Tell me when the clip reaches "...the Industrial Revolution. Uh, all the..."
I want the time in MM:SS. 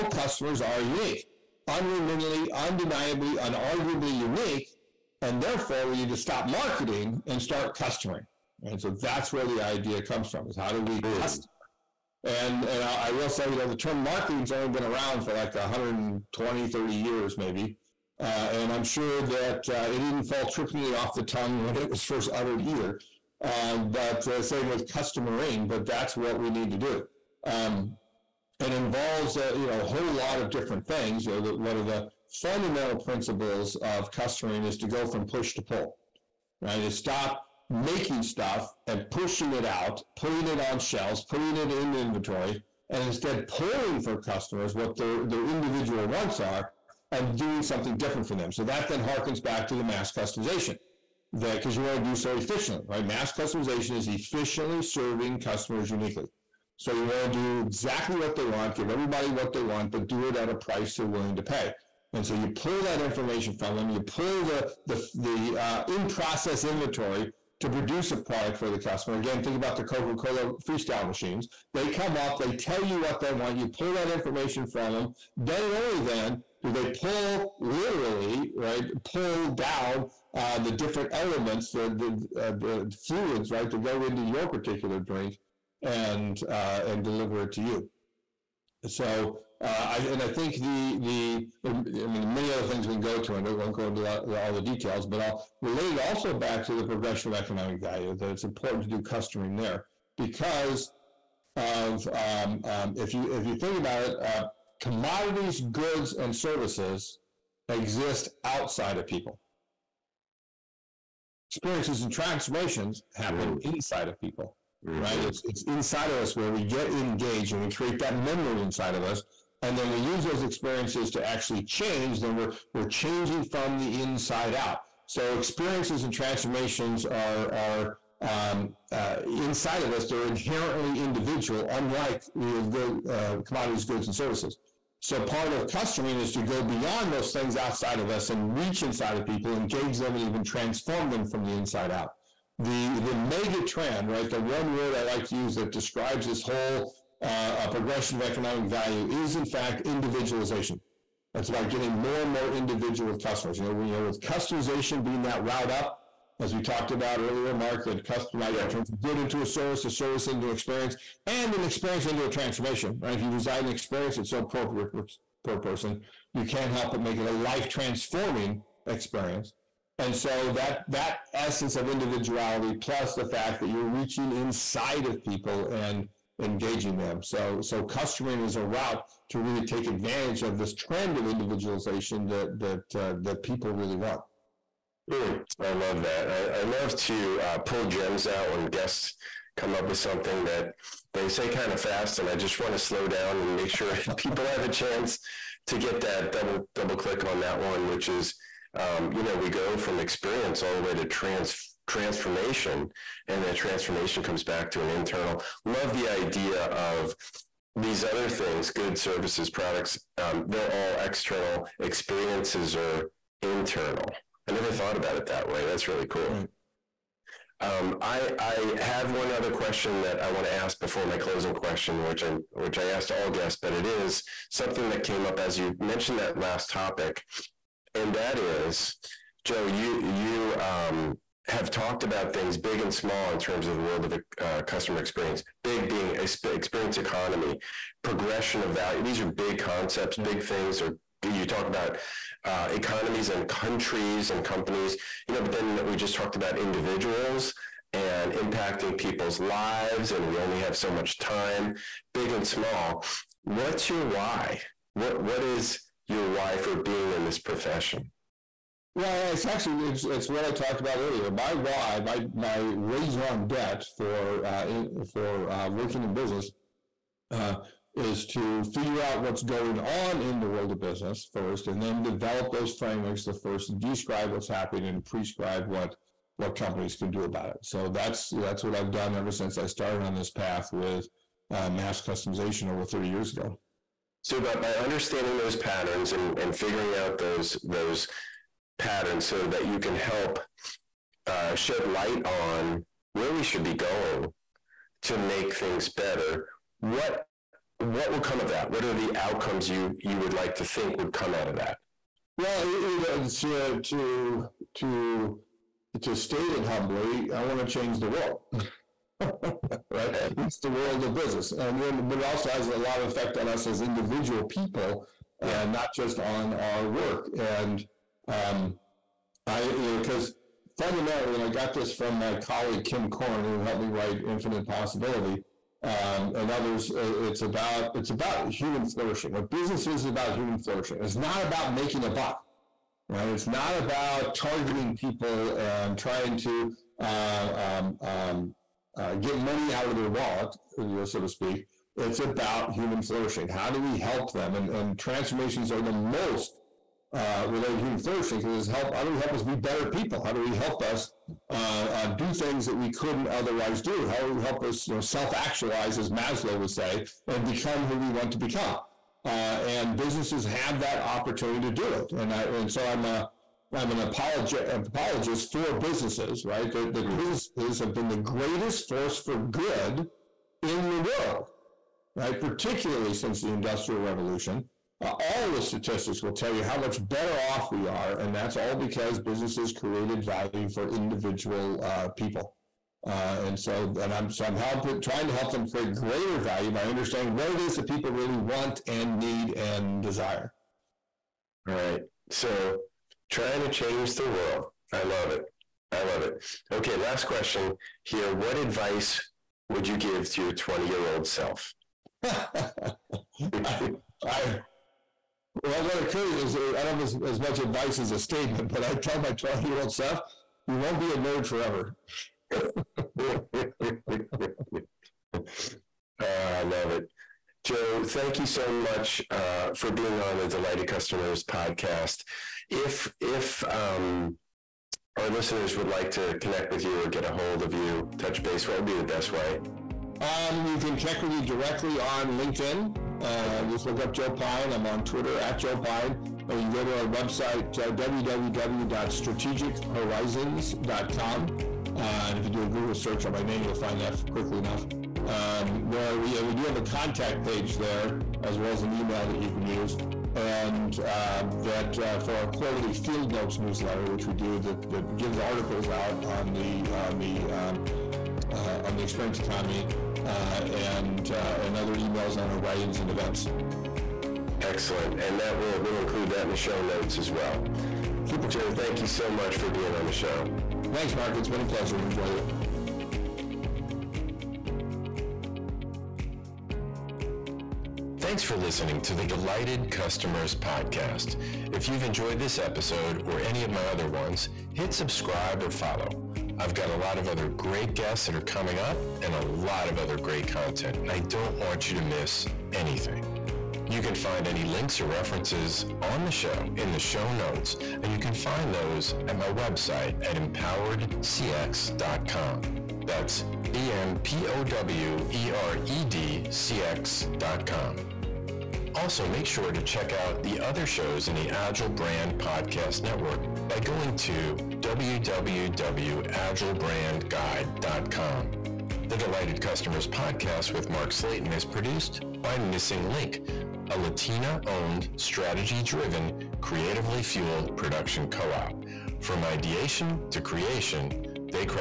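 06:13.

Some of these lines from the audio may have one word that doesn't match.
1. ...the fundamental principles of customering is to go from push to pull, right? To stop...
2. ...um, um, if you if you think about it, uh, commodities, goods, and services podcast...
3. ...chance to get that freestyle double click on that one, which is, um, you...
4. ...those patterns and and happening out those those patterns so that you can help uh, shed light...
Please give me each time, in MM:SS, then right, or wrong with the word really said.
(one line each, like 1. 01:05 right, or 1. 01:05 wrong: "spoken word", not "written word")
1. 00:31 right
2. 01:42 wrong: "exist", not "podcast"
3. 03:14 wrong: "double", not "freestyle"
4. 04:45 wrong: "figuring", not "happening".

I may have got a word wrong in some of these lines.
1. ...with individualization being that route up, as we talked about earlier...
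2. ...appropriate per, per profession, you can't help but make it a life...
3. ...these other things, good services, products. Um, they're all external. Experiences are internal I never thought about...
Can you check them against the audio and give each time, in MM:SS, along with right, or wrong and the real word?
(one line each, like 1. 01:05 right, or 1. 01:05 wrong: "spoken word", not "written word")
1. 02:34 wrong: "customization", not "individualization"
2. 02:44 wrong: "person", not "profession"
3. 03:27 right.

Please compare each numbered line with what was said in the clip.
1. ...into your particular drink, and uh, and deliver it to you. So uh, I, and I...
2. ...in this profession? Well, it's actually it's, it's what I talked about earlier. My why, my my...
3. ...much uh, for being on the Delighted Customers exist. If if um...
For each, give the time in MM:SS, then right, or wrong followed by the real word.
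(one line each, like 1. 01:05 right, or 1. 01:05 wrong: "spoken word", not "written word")
1. 01:24 right
2. 04:17 right
3. 06:58 wrong: "podcast", not "exist".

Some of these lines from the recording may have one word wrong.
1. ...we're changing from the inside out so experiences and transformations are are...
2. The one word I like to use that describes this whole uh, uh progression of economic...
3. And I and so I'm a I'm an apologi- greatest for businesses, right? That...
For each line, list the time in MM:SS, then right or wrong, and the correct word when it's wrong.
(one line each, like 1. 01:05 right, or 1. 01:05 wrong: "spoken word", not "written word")
1. 02:02 right
2. 02:24 right
3. 06:02 wrong: "apologist", not "greatest".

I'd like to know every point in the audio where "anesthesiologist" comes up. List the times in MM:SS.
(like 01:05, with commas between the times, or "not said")
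not said.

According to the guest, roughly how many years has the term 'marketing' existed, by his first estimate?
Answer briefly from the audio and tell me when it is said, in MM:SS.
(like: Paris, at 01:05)
120, at 00:15.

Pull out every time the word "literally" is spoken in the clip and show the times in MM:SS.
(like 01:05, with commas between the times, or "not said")
01:17.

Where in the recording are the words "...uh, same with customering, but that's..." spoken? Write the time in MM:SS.
00:24.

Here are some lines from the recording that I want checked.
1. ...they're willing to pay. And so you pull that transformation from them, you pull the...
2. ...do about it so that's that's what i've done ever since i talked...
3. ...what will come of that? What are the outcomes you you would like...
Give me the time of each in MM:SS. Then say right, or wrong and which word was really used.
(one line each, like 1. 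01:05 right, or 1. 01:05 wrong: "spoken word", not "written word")
1. 01:00 wrong: "information", not "transformation"
2. 04:37 wrong: "started", not "talked"
3. 04:57 right.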